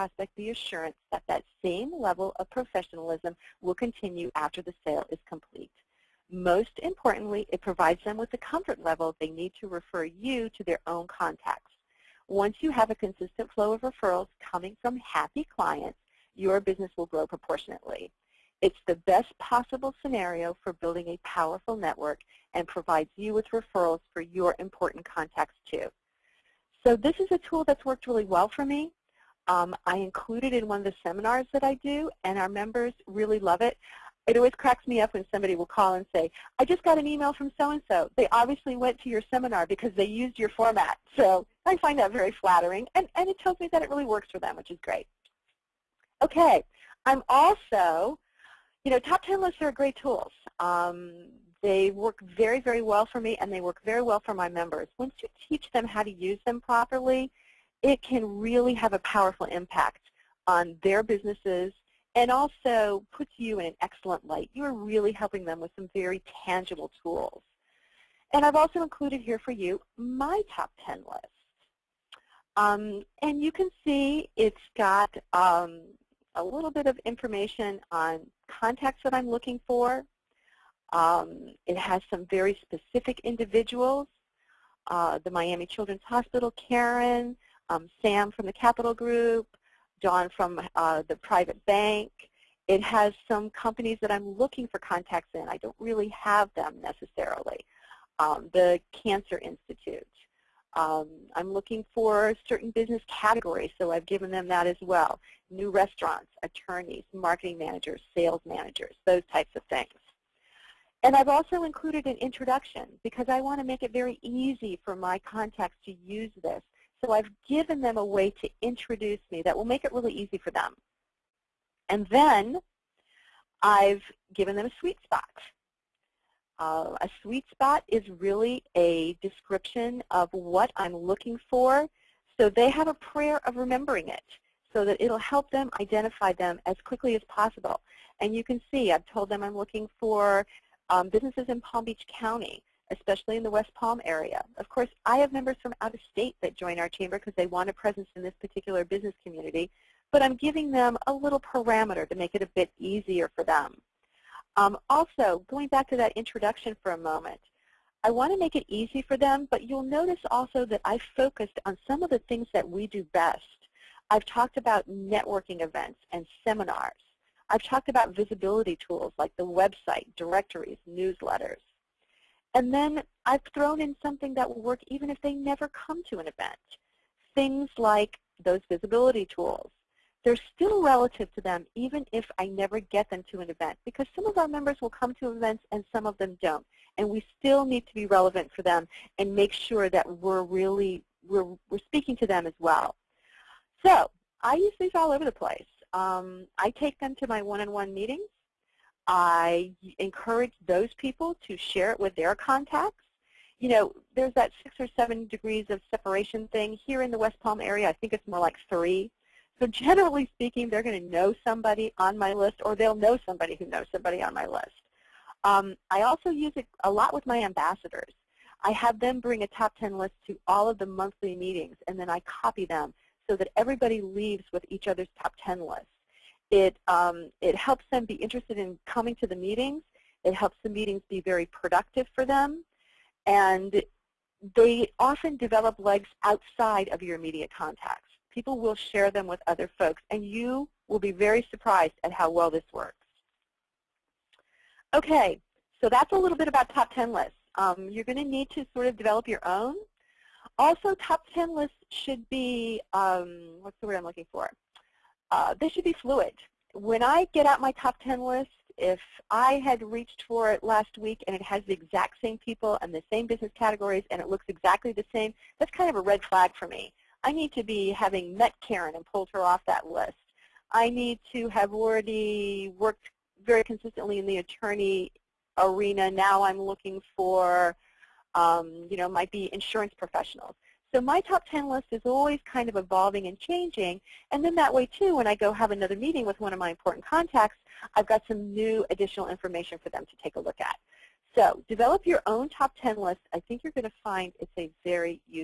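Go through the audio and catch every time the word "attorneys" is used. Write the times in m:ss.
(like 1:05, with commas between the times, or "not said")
1:46, 4:34.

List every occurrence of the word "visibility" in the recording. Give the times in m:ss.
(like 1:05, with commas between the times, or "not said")
2:48, 2:58.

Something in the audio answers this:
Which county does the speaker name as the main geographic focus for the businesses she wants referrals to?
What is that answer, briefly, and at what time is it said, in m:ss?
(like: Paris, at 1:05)
Palm Beach County, at 2:21.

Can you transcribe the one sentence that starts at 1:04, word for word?
You are really helping them with some very tangible tools.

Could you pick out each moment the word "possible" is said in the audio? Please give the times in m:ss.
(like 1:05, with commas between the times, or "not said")
0:19, 2:17.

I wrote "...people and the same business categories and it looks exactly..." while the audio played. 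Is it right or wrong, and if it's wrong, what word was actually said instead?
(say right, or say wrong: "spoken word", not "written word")
right.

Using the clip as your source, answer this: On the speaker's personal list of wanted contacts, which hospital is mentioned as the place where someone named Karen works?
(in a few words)
Miami Children's Hospital.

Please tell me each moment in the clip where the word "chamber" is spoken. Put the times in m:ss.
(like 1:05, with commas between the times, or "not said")
2:26.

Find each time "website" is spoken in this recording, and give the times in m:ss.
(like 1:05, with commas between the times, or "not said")
2:49.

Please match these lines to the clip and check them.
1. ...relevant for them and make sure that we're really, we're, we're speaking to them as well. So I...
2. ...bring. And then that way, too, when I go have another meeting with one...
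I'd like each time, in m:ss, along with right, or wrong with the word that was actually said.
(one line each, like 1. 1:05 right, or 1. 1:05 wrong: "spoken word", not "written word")
1. 3:08 right
2. 4:43 wrong: "changing", not "bring".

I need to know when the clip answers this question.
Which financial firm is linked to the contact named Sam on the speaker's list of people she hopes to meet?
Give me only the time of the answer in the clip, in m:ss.
1:28.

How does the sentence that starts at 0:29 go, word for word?
Um, I include it in one of the seminars that I do, and our members really love it.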